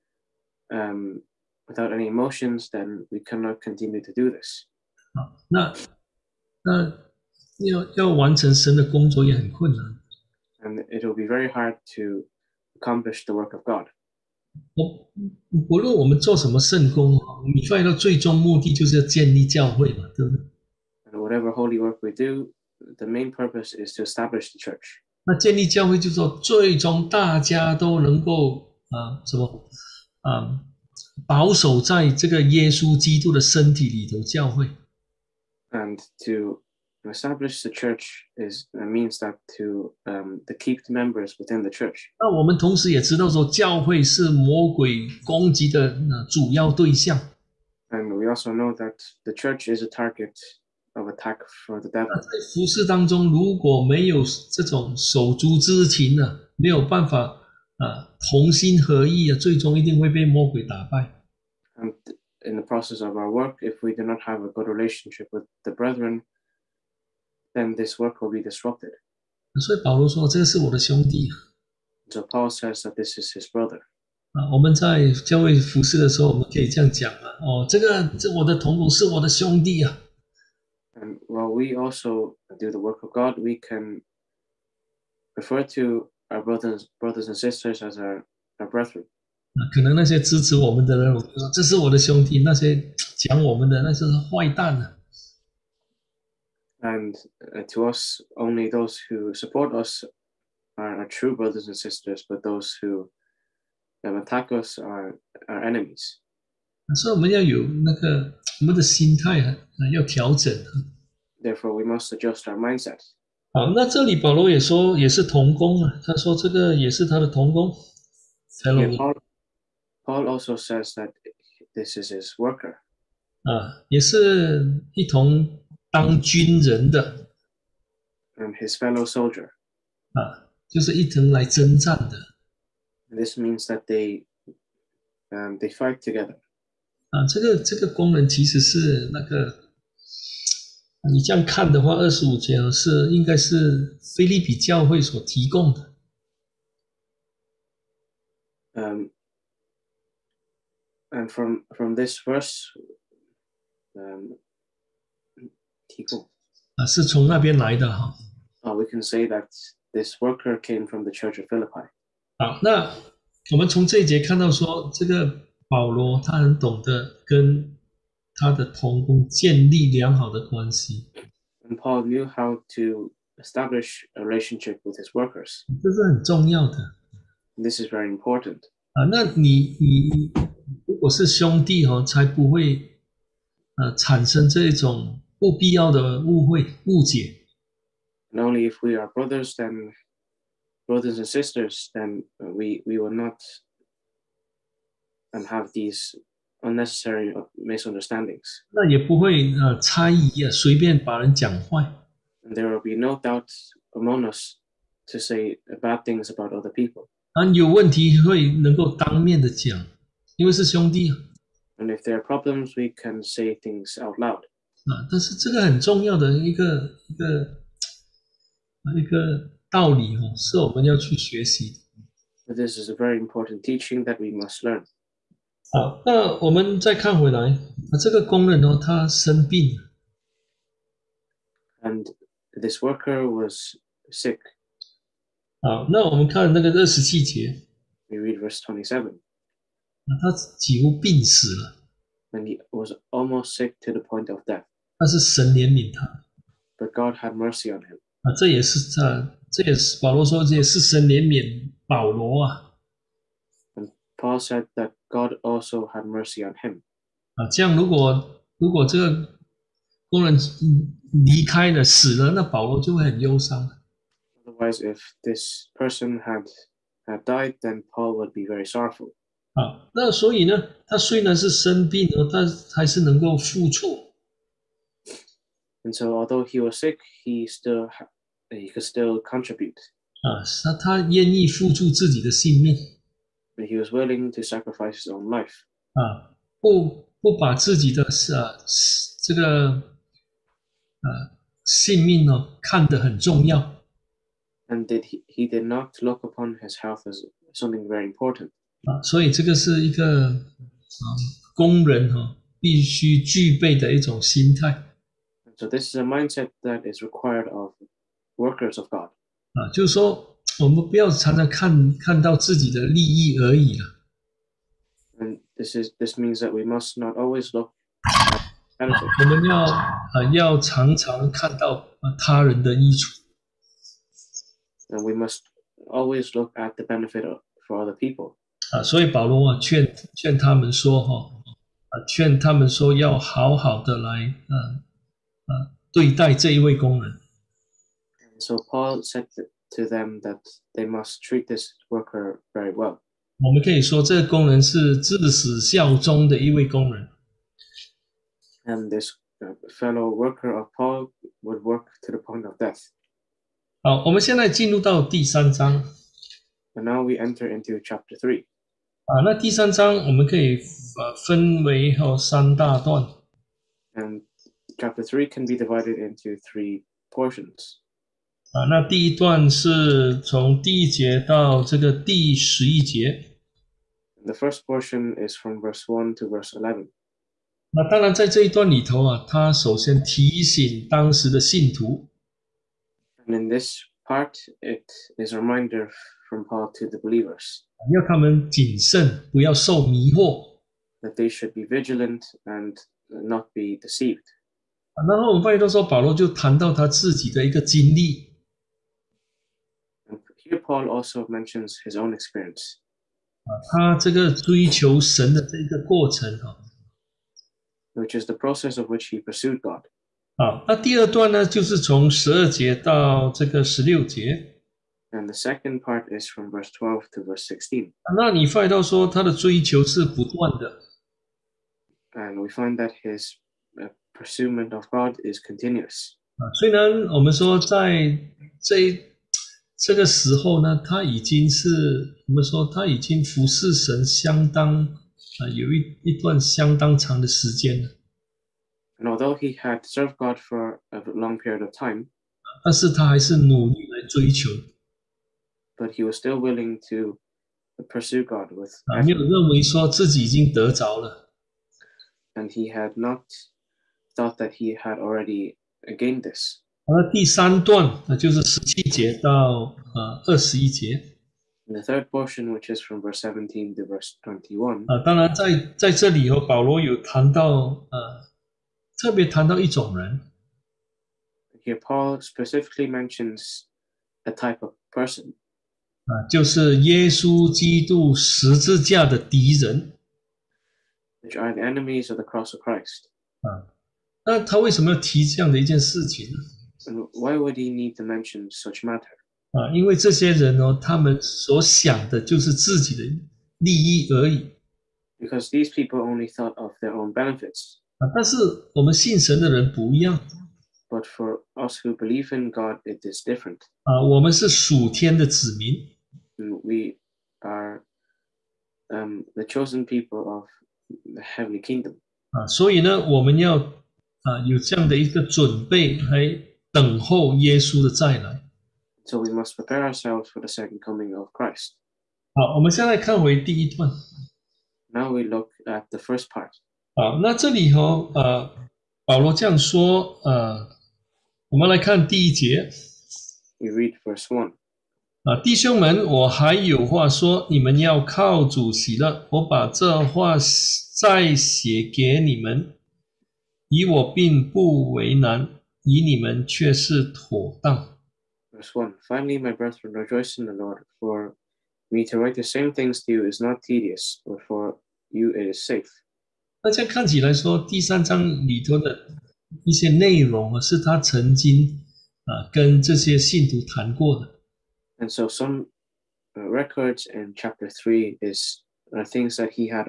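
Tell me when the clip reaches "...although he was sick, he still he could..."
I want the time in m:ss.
4:36.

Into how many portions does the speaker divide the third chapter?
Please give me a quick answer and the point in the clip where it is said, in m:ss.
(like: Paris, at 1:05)
3, at 6:06.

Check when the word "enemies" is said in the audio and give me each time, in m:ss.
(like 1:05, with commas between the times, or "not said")
1:45, 8:01.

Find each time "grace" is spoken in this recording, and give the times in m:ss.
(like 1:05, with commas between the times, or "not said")
not said.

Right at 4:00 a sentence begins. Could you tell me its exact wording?
那 他 几 乎 病 死 了。 And he was almost sick to the point of death.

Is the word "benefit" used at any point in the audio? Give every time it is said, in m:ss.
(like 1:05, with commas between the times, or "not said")
5:26, 8:17.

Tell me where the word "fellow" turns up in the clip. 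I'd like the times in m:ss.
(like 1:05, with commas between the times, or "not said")
2:08, 5:49.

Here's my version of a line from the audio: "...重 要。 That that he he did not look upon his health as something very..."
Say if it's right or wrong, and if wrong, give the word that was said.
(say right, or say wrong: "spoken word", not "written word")
wrong: "And", not "That".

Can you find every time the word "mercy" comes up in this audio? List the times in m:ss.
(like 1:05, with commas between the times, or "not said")
4:07, 4:16.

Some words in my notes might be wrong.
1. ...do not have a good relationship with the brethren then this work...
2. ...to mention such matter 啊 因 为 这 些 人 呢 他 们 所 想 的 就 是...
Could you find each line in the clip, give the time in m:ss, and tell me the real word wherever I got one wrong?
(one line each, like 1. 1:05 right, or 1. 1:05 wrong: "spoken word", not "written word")
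1. 1:03 right
2. 8:07 right.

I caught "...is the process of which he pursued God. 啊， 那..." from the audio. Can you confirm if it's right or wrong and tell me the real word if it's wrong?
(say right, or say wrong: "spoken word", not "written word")
right.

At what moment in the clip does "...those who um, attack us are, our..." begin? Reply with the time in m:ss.
1:42.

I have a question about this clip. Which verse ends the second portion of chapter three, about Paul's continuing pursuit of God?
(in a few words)
verse 16.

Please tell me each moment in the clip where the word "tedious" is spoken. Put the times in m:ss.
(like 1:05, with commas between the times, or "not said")
9:13.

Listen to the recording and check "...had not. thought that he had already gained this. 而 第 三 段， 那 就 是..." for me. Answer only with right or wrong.
right.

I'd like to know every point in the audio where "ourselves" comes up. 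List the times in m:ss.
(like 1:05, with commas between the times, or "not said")
8:39.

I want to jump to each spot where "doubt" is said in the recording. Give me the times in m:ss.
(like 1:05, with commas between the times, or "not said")
3:23.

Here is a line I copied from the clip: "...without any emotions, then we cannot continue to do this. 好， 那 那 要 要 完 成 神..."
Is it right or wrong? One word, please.
right.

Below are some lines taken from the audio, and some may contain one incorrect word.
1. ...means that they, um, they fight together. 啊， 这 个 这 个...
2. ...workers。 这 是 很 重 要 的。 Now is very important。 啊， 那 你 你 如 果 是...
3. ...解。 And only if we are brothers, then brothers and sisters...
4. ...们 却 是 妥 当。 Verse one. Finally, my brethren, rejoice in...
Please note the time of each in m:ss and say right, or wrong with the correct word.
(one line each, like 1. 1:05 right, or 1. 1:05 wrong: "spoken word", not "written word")
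1. 2:13 right
2. 2:55 wrong: "This", not "Now"
3. 3:07 right
4. 9:06 right.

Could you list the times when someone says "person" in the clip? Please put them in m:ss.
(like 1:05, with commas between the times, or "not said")
4:25, 7:54.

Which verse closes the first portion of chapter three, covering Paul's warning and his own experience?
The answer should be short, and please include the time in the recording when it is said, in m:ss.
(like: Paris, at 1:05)
verse 11, at 6:16.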